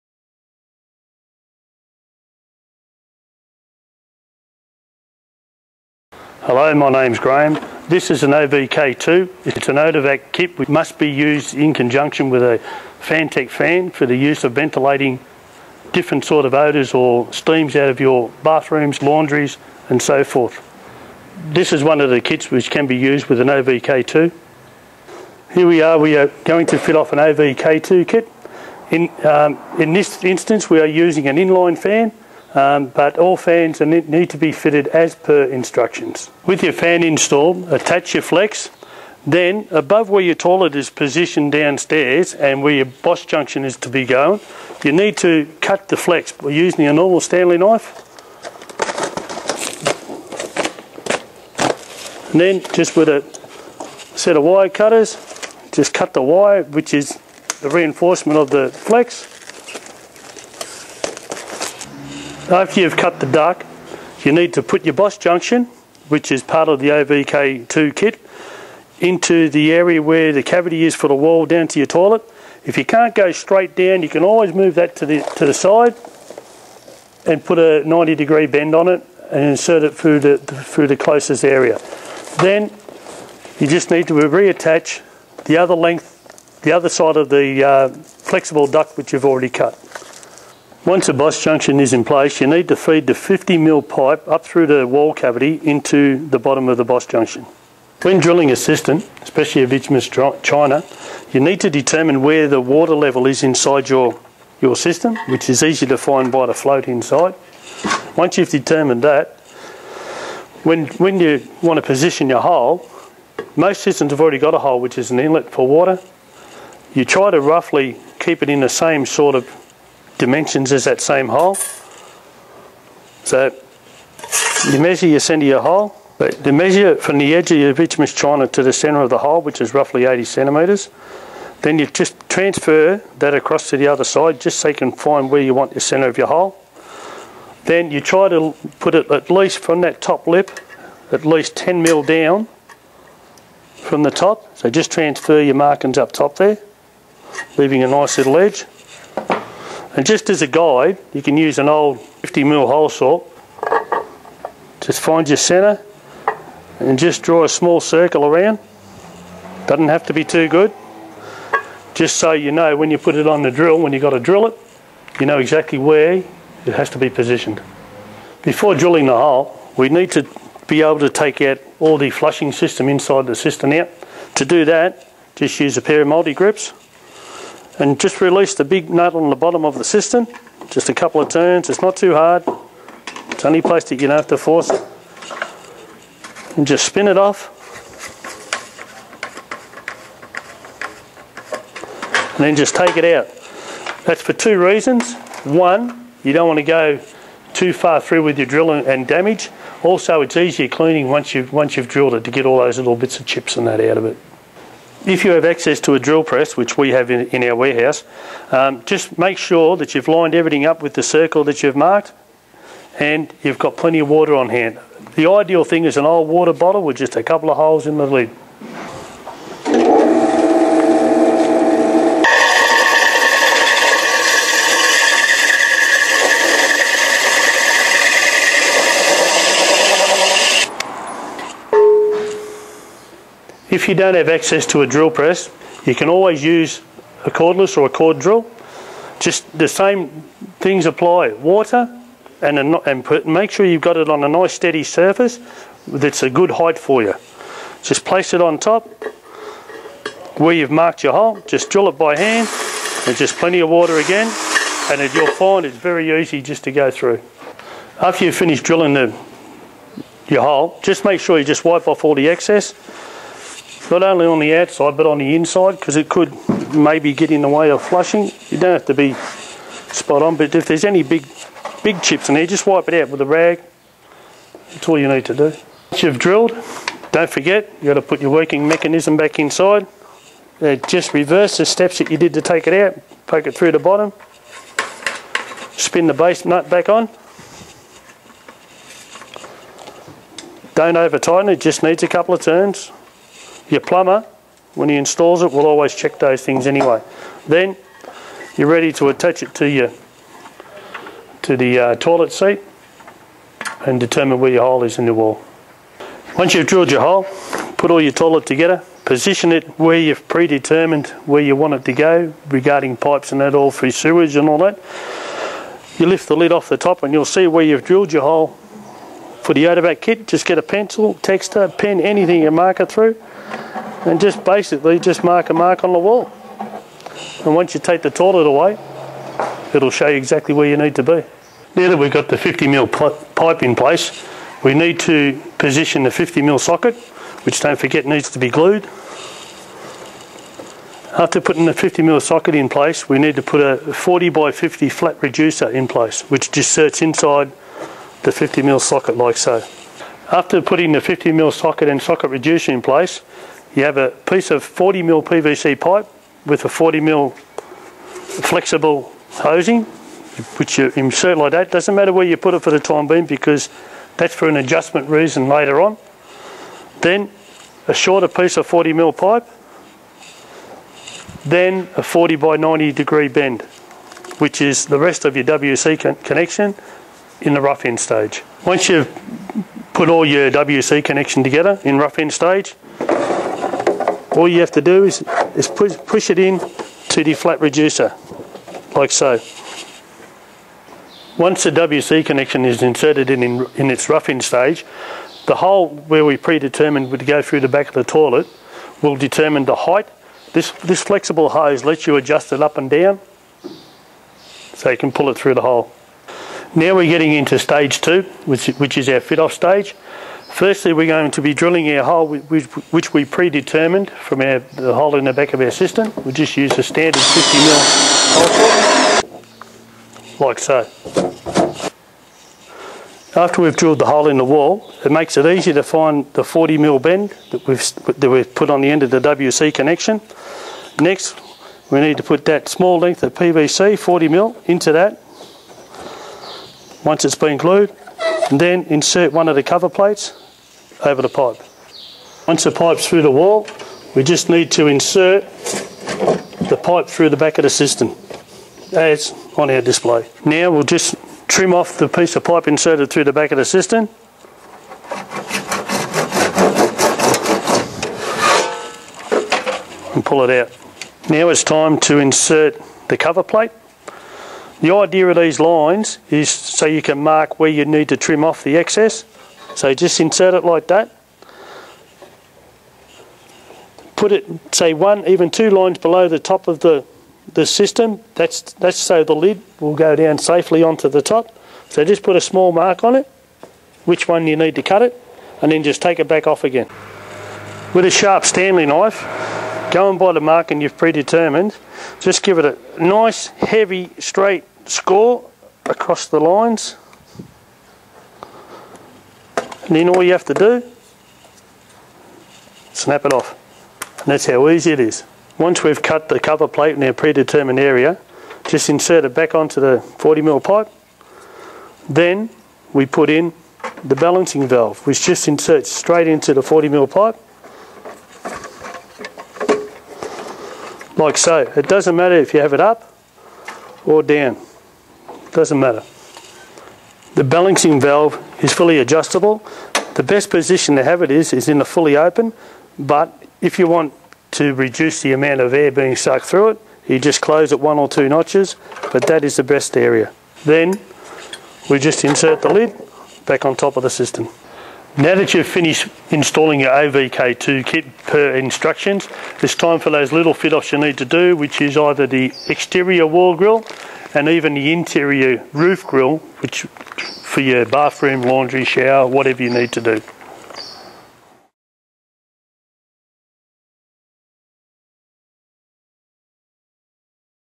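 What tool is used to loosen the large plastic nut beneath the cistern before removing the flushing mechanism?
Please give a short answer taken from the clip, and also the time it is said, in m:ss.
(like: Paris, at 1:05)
multi-grips, at 2:56.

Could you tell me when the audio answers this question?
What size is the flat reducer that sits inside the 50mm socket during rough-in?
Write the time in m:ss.
5:43.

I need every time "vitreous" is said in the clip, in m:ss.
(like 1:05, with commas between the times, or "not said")
1:39, 2:07.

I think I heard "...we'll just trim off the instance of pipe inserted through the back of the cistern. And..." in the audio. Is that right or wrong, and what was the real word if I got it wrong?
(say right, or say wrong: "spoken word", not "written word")
wrong: "piece", not "instance".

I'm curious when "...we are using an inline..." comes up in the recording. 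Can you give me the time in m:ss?
0:30.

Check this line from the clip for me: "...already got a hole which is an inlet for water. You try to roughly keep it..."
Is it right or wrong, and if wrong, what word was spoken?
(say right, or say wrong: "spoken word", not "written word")
right.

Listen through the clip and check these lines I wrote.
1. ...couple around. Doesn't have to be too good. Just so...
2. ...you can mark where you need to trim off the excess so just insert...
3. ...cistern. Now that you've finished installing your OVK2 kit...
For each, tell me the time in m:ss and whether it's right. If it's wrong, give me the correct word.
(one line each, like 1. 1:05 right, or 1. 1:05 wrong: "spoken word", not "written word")
1. 2:37 wrong: "circle", not "couple"
2. 7:46 right
3. 9:04 right.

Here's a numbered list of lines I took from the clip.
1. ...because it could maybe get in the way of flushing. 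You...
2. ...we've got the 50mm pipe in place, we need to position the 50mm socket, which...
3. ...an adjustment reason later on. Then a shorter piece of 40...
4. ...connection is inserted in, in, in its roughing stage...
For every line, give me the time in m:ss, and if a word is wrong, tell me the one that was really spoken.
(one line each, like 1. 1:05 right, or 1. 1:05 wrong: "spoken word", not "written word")
1. 4:25 right
2. 5:31 right
3. 6:04 right
4. 6:32 right.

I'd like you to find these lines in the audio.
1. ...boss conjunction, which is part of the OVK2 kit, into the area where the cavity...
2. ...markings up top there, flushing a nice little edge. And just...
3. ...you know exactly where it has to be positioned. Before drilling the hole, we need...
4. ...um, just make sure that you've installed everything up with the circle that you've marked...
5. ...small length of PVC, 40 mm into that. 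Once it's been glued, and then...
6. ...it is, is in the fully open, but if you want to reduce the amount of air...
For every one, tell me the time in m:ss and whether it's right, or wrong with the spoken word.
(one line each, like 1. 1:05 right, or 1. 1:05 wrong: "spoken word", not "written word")
1. 1:04 wrong: "junction", not "conjunction"
2. 2:25 wrong: "leaving", not "flushing"
3. 2:45 right
4. 3:28 wrong: "lined", not "installed"
5. 7:12 right
6. 8:51 right.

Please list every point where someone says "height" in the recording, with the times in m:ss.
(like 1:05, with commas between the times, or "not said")
4:06, 6:39.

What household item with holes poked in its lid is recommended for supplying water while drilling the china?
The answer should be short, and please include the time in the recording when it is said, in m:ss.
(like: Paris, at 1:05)
old water bottle, at 3:36.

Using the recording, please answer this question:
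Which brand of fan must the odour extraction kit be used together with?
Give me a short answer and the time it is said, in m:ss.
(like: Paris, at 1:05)
Fantech, at 0:12.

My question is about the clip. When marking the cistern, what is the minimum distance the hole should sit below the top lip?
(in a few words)
10 mm.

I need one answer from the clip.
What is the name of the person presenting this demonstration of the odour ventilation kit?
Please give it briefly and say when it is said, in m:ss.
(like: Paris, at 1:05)
Graham, at 0:07.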